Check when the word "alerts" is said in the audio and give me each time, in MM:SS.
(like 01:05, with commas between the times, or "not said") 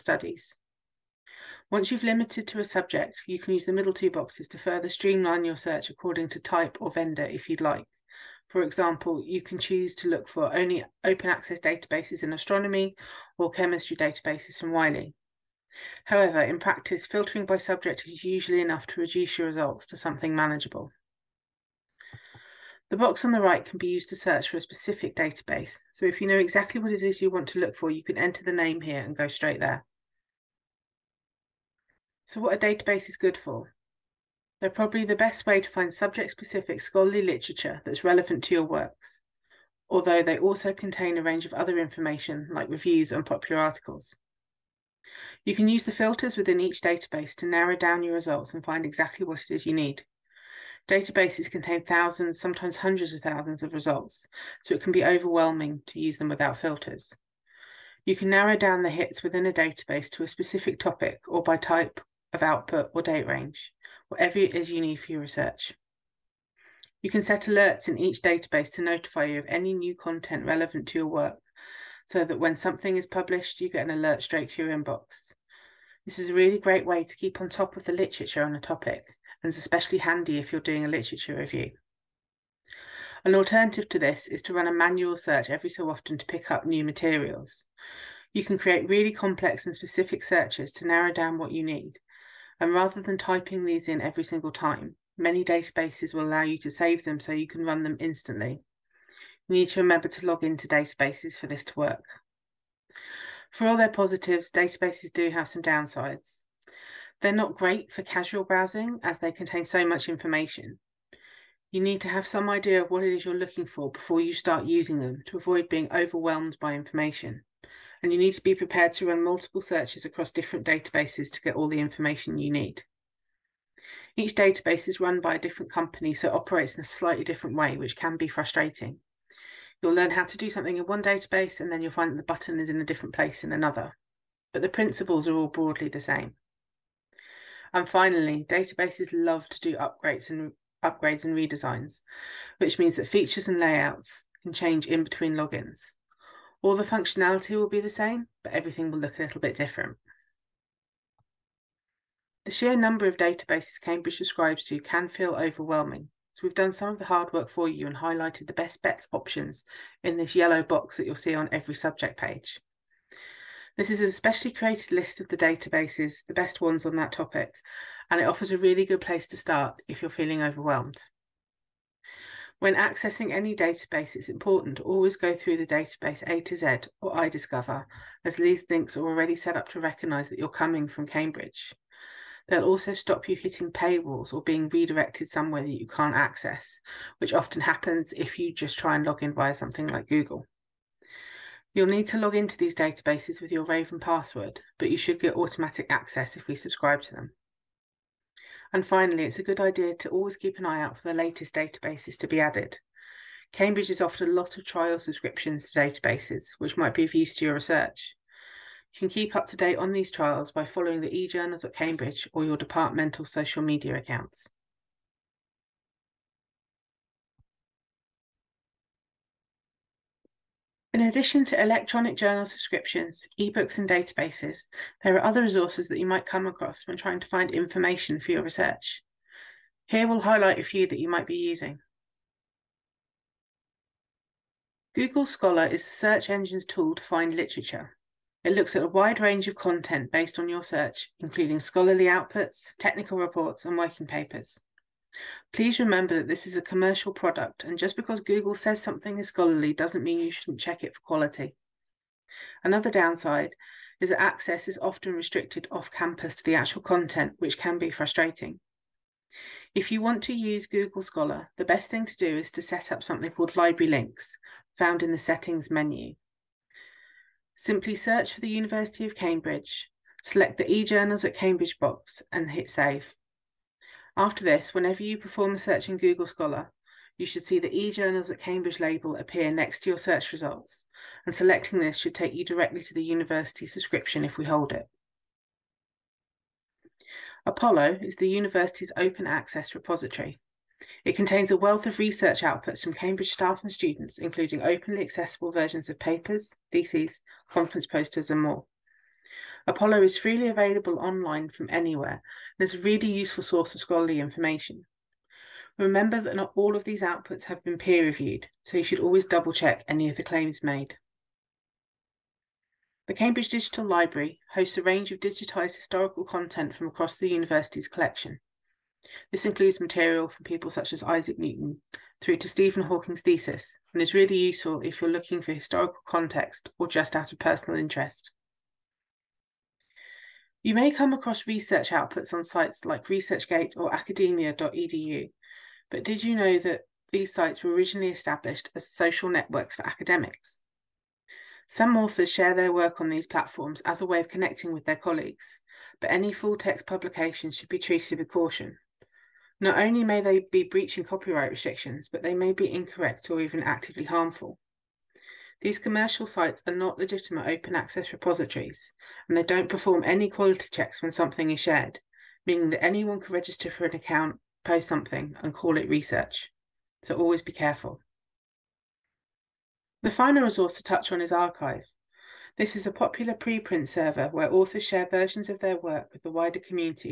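01:07, 01:13.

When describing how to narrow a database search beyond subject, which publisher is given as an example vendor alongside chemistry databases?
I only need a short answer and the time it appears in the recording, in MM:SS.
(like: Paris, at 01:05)
Wiley, at 00:14.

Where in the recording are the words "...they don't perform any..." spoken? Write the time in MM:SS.
05:59.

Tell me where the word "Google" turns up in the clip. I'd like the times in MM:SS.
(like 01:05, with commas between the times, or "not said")
03:10, 03:54, 04:08, 04:20, 04:35.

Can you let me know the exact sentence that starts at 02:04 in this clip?
Each database is run by a different company, so it operates in a slightly different way, which can be frustrating.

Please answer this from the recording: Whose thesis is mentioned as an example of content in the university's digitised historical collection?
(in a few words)
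Stephen Hawking.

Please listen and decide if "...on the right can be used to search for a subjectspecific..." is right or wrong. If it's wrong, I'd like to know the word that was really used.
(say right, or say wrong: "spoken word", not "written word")
wrong: "specific", not "subjectspecific".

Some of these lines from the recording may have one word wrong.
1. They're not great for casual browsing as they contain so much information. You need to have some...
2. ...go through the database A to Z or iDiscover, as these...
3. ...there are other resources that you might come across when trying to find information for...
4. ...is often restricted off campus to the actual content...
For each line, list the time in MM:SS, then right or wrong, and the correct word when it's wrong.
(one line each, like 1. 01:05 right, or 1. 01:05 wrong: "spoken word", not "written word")
1. 01:47 right
2. 02:55 right
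3. 03:45 right
4. 04:14 right.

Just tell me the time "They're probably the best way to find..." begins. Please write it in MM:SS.
00:34.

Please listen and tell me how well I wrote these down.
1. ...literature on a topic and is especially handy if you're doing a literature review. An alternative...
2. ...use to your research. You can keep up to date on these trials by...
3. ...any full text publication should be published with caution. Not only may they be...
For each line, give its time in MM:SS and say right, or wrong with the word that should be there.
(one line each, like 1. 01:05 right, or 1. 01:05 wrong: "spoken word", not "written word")
1. 01:17 right
2. 03:27 right
3. 05:46 wrong: "treated", not "published".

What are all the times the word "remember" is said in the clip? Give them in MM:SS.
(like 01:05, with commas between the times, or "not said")
01:39, 04:05, 05:05.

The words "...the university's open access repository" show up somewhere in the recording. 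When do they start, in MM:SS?
04:48.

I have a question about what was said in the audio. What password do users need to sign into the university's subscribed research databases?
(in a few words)
Raven.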